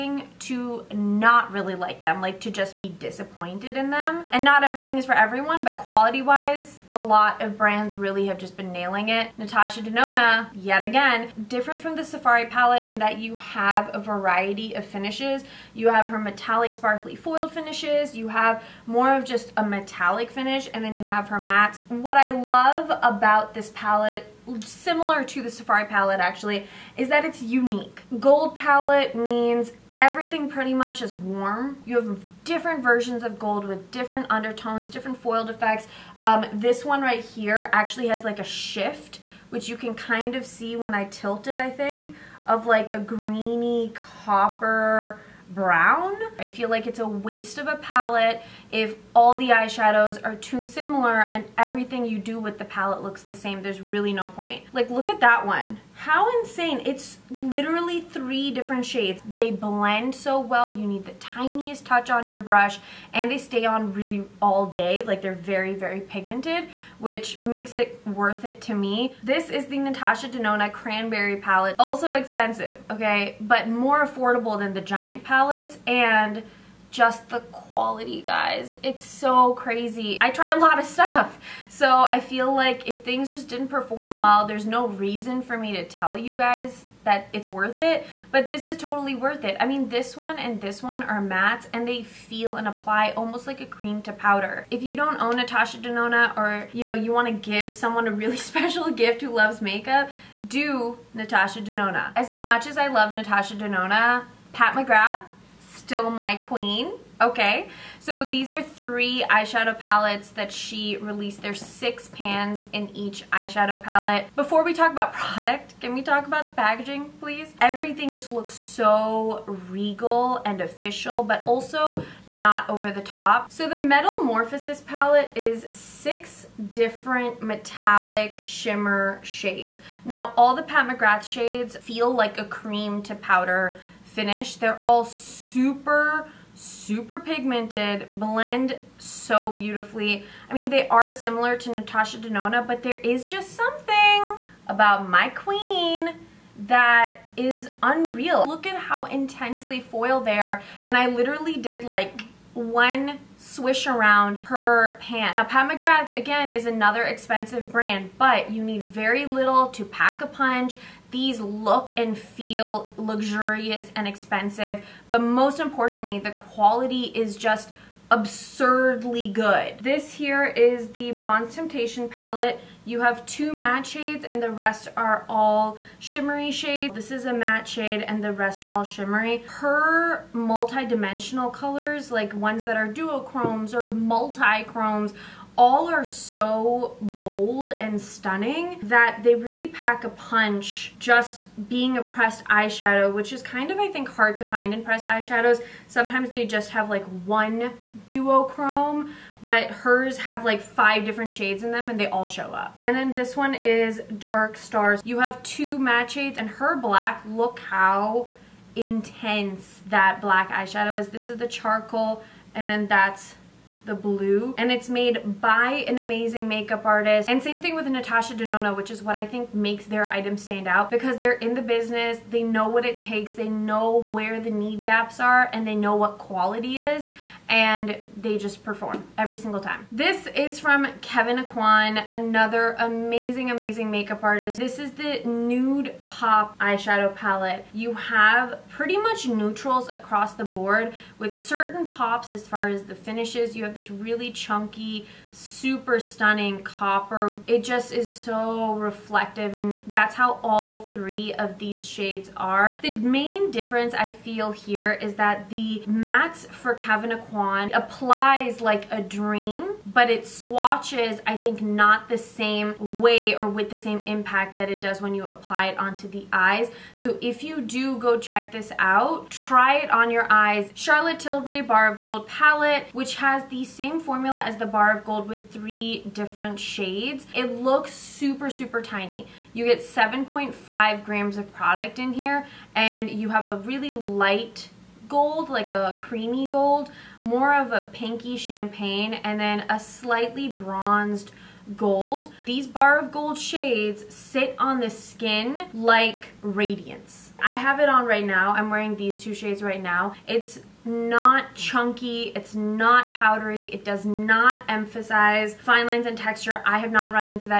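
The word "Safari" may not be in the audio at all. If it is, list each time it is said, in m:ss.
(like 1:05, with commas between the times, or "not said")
0:12, 0:25.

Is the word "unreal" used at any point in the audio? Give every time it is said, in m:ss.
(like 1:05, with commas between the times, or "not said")
2:27.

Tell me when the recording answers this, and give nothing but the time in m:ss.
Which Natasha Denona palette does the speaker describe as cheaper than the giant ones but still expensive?
1:10.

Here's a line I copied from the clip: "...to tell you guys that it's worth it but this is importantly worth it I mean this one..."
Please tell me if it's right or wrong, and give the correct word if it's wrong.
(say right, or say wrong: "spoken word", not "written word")
wrong: "totally", not "importantly".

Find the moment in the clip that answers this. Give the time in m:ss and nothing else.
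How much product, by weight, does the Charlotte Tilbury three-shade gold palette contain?
4:39.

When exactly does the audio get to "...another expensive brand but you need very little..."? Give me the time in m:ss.
2:36.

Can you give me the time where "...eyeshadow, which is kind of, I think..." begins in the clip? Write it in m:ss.
3:12.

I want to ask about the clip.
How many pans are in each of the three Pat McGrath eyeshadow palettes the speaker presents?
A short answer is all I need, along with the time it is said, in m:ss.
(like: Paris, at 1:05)
6, at 1:51.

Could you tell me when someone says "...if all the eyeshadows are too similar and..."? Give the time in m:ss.
0:48.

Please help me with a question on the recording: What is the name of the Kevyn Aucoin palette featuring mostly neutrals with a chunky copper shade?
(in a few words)
Nude Pop.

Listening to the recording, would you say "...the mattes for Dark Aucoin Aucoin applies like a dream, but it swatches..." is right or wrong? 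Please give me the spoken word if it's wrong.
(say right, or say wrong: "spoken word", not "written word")
wrong: "Kevyn", not "Dark".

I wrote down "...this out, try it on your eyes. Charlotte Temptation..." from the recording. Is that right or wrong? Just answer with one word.
wrong.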